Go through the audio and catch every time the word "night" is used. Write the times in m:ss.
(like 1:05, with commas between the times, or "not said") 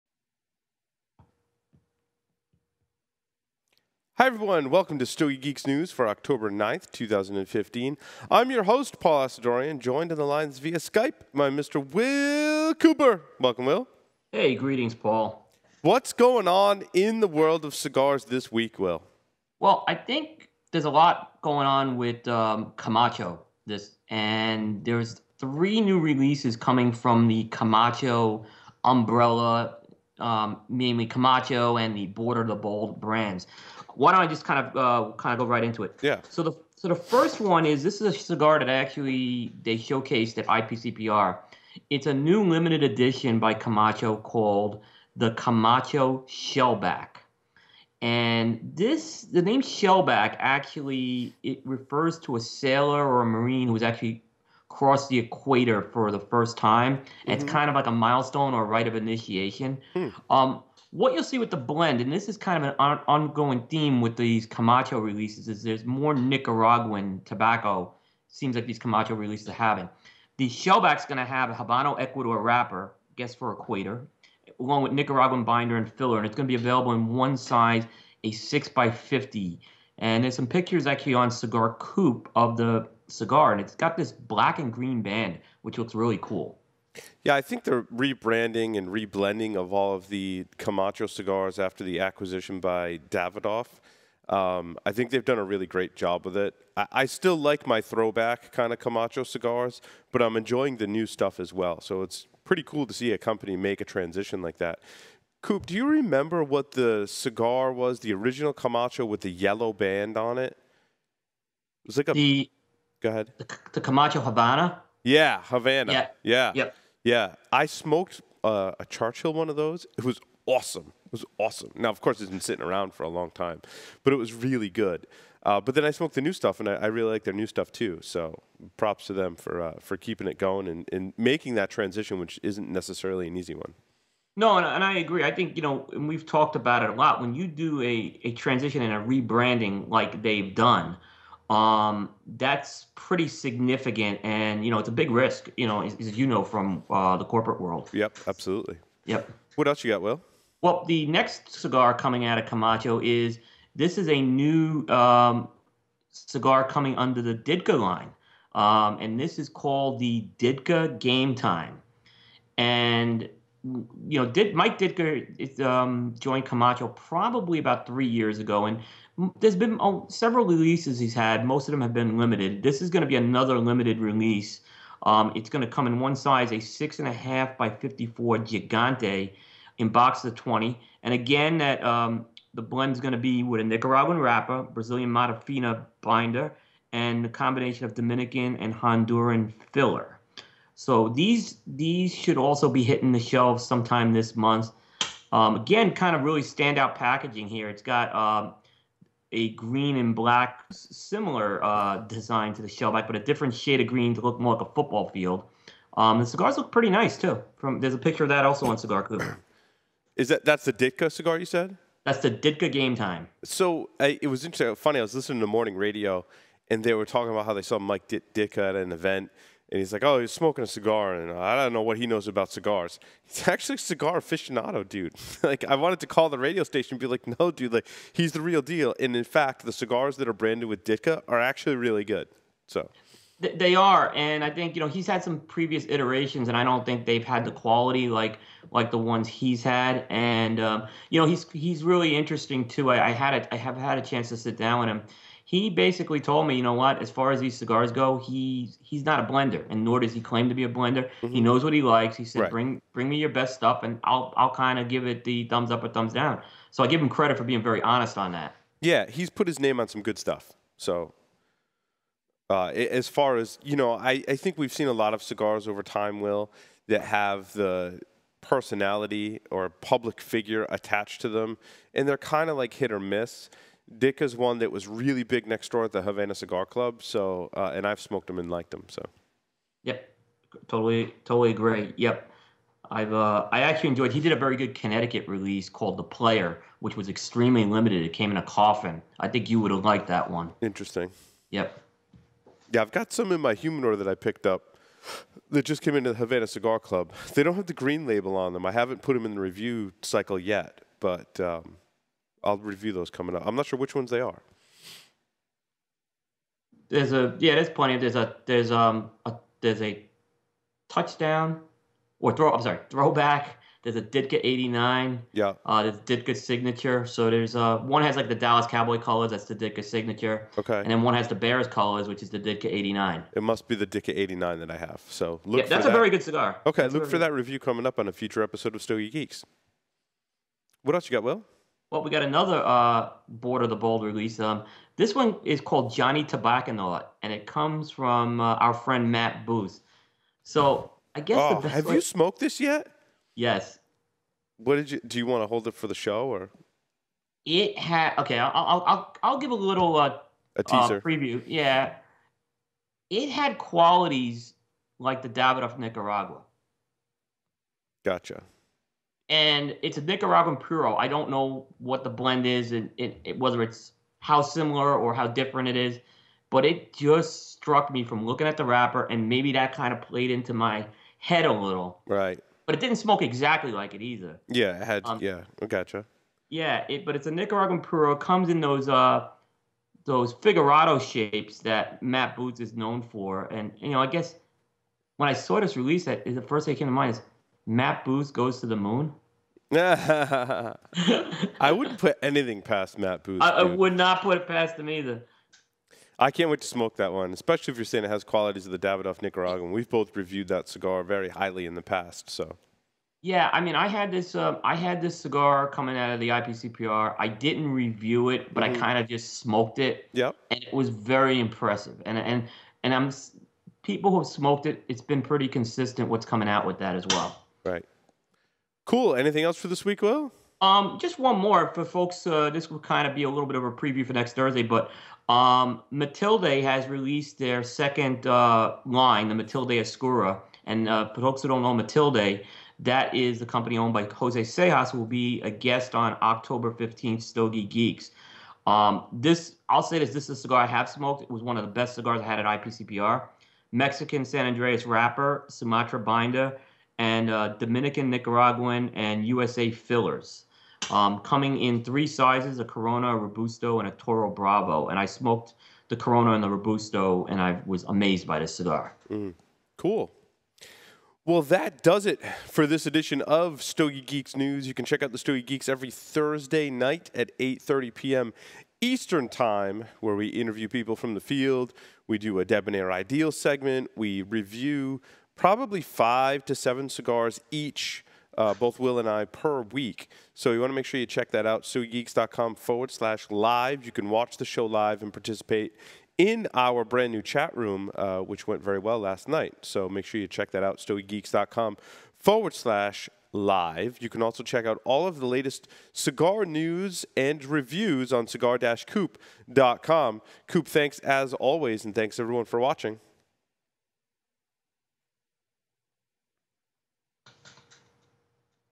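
7:46, 8:09.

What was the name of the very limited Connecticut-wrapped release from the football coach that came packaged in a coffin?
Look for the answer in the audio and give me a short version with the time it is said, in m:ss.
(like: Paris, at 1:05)
The Player, at 4:45.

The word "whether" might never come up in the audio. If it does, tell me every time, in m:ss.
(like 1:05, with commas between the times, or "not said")
6:03.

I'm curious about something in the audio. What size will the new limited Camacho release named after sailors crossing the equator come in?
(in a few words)
6 by 50.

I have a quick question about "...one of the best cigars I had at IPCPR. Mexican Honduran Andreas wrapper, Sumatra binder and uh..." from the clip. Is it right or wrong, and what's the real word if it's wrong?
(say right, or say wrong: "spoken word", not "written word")
wrong: "San", not "Honduran".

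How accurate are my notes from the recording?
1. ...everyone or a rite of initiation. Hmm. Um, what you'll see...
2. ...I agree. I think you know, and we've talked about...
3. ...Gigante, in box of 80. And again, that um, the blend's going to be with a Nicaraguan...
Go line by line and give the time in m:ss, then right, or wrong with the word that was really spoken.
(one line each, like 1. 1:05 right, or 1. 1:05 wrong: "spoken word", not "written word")
1. 0:57 wrong: "milestone", not "everyone"
2. 2:14 right
3. 2:58 wrong: "20", not "80".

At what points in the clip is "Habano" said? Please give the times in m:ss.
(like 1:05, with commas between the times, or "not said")
1:11.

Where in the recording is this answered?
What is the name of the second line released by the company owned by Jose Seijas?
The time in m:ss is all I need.
7:09.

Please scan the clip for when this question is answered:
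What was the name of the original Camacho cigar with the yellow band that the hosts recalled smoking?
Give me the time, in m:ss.
1:53.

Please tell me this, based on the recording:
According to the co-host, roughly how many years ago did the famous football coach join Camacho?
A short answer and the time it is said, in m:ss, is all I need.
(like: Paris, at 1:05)
3, at 2:47.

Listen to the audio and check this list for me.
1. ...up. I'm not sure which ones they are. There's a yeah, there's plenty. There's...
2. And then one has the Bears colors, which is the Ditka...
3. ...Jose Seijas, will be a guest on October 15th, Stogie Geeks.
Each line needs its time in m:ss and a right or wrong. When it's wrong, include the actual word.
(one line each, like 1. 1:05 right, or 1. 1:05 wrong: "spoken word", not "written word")
1. 5:03 right
2. 5:20 right
3. 7:14 right.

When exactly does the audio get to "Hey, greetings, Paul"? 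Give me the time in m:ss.
0:14.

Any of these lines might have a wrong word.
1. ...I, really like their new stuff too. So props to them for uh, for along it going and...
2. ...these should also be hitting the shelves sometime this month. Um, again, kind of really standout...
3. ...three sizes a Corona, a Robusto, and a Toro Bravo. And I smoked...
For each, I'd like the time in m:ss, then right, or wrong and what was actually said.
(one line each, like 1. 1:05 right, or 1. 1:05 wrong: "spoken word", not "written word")
1. 2:06 wrong: "keeping", not "along"
2. 3:11 right
3. 7:31 right.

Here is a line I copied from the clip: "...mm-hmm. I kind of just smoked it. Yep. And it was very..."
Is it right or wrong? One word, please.
right.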